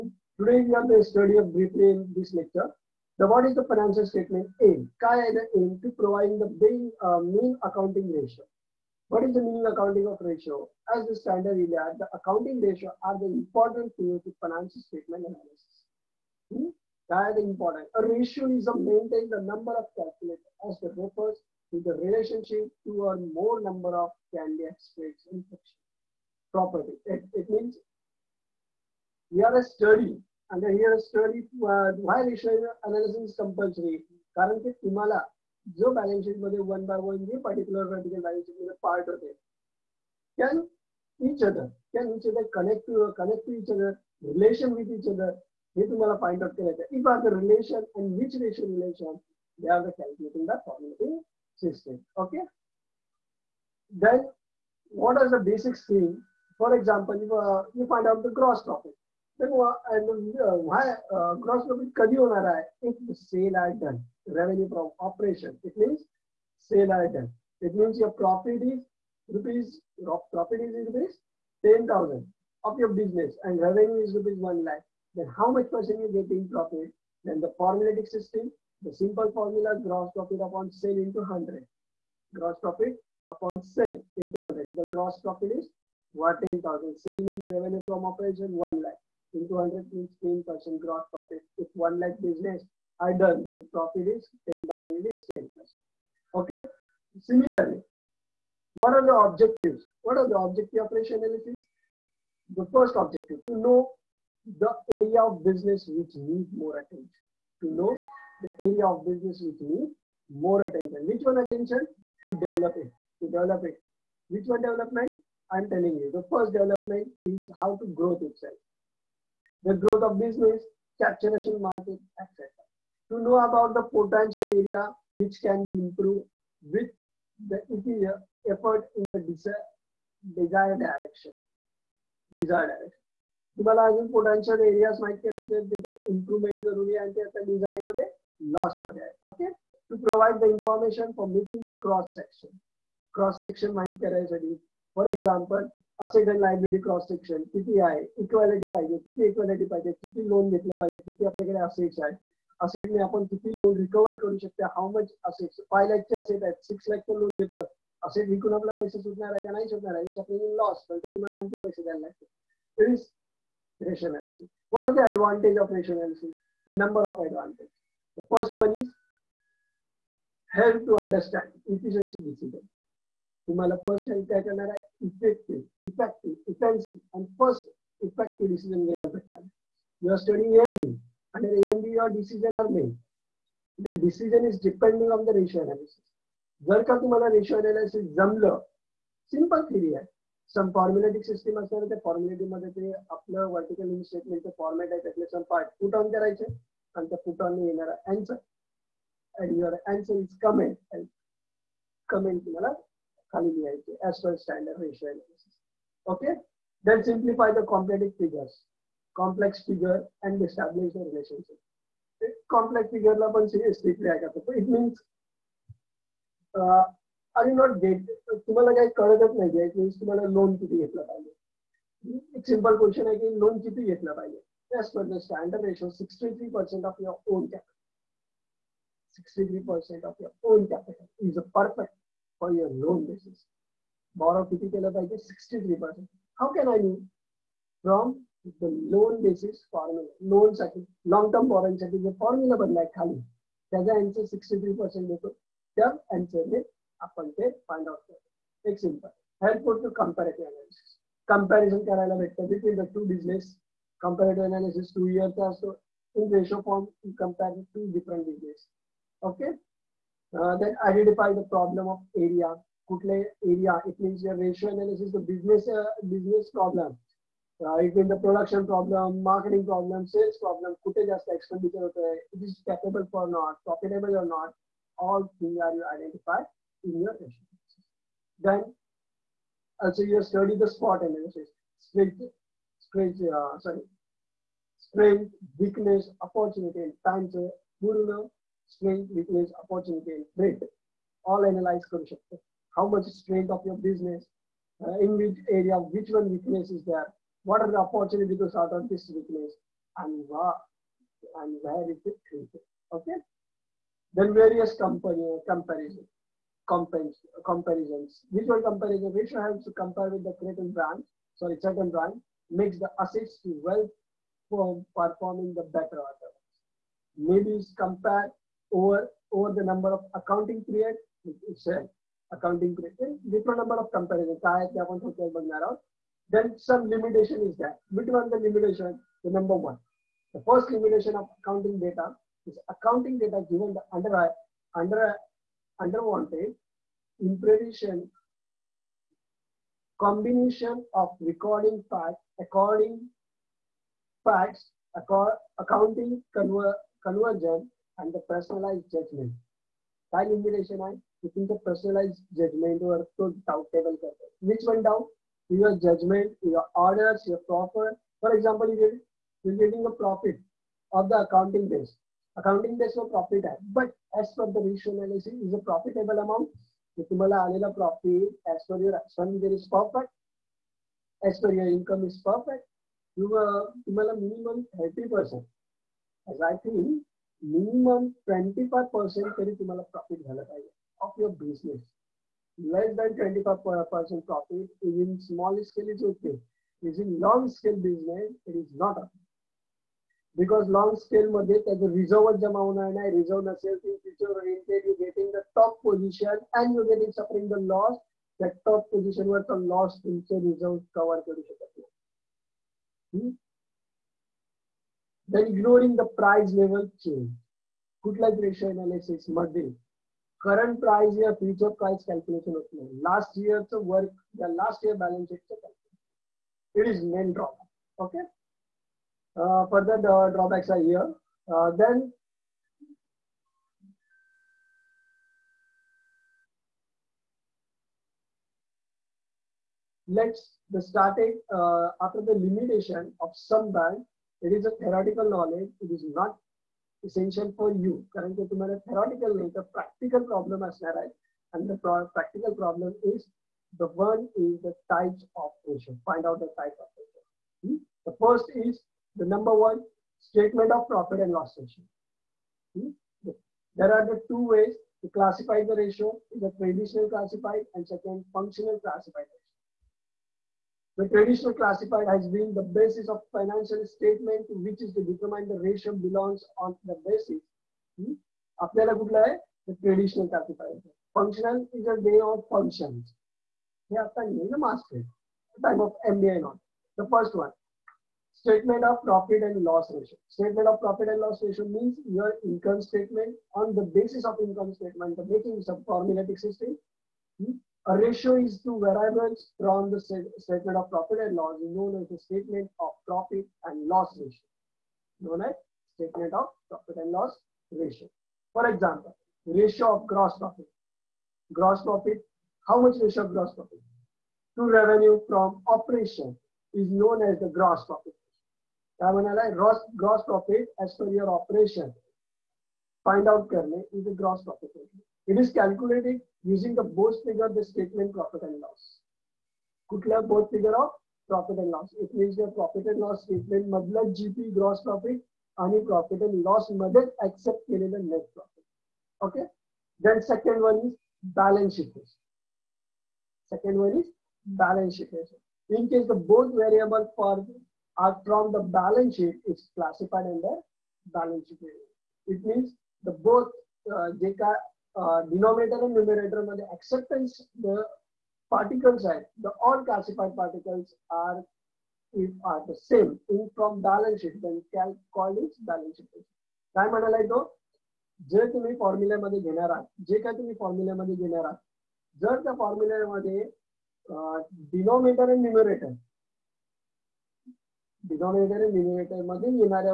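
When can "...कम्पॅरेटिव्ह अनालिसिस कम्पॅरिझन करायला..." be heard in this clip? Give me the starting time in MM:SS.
04:09.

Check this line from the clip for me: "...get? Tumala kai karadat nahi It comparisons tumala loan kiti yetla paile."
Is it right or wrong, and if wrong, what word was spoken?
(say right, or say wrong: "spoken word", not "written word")
wrong: "means", not "comparisons".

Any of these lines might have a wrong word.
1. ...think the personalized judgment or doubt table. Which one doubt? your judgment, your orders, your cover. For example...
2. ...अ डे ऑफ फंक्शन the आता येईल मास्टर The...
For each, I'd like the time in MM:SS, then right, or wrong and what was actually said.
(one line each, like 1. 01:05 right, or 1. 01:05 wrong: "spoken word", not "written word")
1. 05:51 wrong: "proper", not "cover"
2. 07:51 right.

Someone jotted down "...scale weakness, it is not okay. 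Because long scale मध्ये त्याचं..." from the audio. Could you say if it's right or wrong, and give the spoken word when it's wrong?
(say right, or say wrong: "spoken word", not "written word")
wrong: "business", not "weakness".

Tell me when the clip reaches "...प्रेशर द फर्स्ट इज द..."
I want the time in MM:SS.
07:26.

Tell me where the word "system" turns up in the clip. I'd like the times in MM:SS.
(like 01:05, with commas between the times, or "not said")
01:18, 08:06.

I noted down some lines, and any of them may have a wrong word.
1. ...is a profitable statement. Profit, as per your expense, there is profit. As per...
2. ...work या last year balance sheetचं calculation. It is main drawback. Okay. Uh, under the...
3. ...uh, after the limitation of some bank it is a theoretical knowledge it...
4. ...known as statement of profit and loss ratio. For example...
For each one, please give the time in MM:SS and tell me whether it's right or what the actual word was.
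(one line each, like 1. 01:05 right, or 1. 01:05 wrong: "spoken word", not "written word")
1. 06:05 wrong: "amount", not "statement"
2. 06:53 wrong: "further", not "under"
3. 07:11 right
4. 08:15 right.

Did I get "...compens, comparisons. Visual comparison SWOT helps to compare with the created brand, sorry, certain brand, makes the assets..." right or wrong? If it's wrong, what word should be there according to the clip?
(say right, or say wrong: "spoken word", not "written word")
wrong: "Which", not "SWOT".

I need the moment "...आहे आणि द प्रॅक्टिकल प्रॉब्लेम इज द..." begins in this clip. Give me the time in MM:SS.
07:20.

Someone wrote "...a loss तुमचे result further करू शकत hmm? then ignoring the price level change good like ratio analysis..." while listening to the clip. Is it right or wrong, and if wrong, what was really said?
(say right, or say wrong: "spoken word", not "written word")
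wrong: "cover", not "further".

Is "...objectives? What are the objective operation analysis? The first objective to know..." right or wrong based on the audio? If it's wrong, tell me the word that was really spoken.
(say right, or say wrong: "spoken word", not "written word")
right.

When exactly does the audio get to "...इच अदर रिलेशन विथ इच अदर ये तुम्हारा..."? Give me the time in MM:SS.
00:43.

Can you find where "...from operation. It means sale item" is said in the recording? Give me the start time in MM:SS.
01:04.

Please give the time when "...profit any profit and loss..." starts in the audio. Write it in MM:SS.
08:44.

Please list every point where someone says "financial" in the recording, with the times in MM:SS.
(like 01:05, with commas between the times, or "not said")
00:03, 00:14, 07:43.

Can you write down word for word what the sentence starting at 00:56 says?
फॉर example, इफ यू फाइंड आउट द ग्रॉस प्रॉफिट profit.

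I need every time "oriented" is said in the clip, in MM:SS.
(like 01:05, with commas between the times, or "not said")
06:34.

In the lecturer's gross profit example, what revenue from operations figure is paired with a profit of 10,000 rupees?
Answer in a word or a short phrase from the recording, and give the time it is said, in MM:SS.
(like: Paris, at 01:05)
1 lakh, at 01:13.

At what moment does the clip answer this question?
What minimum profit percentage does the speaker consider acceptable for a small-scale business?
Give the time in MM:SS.
06:17.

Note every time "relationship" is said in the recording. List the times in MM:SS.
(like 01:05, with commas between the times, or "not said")
00:21, 03:30.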